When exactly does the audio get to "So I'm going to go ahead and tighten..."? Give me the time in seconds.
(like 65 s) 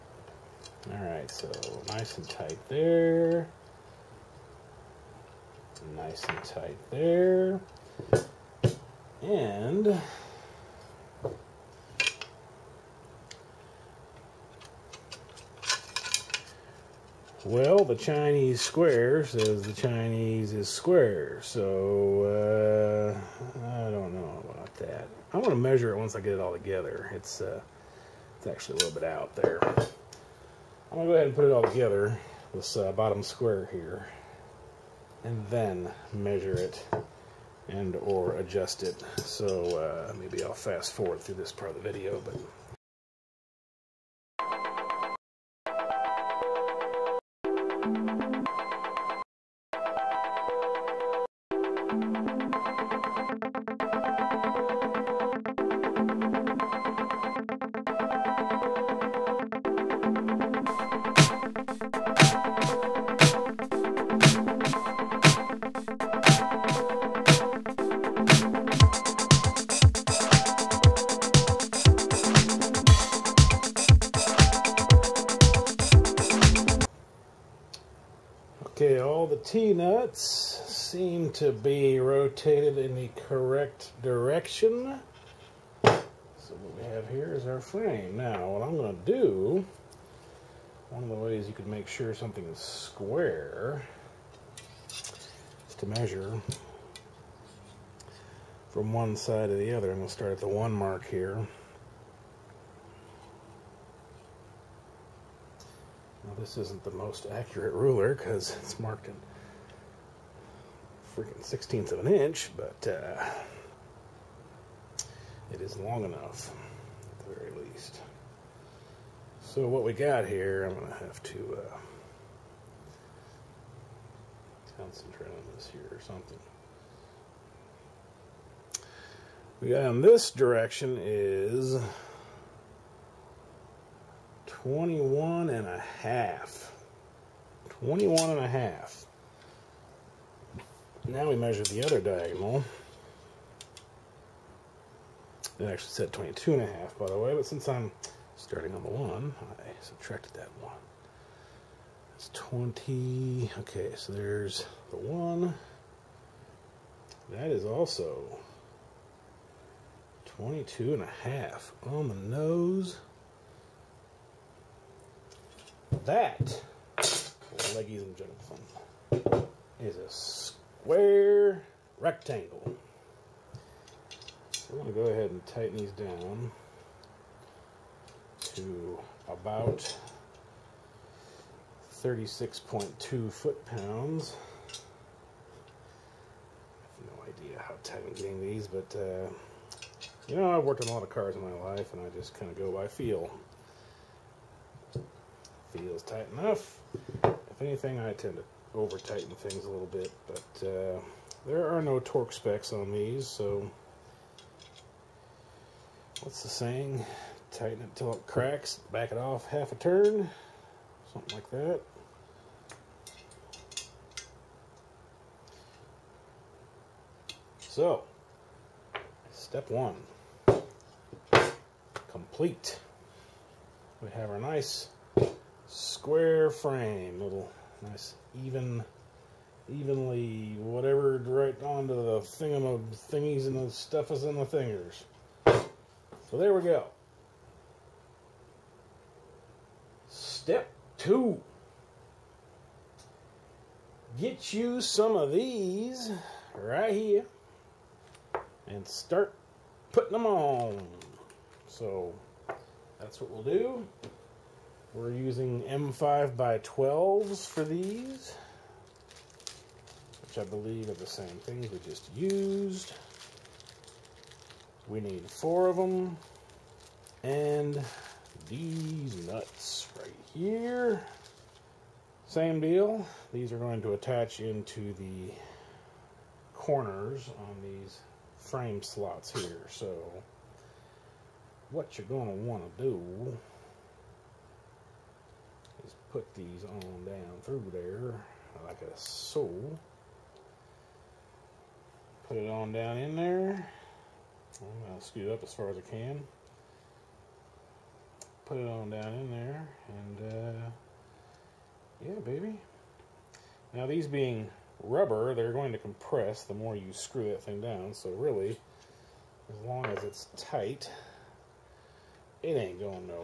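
174 s.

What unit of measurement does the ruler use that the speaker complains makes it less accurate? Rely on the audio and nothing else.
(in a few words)
sixteenths of an inch.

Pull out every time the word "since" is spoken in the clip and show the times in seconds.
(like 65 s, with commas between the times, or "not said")
147 s.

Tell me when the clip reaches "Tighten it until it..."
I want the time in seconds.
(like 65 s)
207 s.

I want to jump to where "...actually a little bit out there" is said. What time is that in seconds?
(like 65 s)
28 s.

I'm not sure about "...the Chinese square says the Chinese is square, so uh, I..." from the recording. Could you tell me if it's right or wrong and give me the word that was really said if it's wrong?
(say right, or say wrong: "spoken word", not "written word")
right.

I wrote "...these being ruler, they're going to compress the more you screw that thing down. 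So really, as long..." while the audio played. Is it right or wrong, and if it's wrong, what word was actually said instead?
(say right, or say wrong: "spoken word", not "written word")
wrong: "rubber", not "ruler".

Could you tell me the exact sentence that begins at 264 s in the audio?
We need four of them and these nuts right here.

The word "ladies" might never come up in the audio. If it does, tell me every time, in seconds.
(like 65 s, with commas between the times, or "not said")
167 s.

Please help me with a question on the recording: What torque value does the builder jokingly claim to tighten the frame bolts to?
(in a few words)
36.2 foot-pounds.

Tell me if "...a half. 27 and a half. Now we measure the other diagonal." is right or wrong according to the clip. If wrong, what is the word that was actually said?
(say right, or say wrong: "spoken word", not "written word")
wrong: "21", not "27".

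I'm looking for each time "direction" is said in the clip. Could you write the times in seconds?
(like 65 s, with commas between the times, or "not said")
84 s, 130 s.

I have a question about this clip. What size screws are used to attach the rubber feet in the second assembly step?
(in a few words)
M5 by 12.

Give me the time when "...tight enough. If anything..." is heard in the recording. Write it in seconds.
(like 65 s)
196 s.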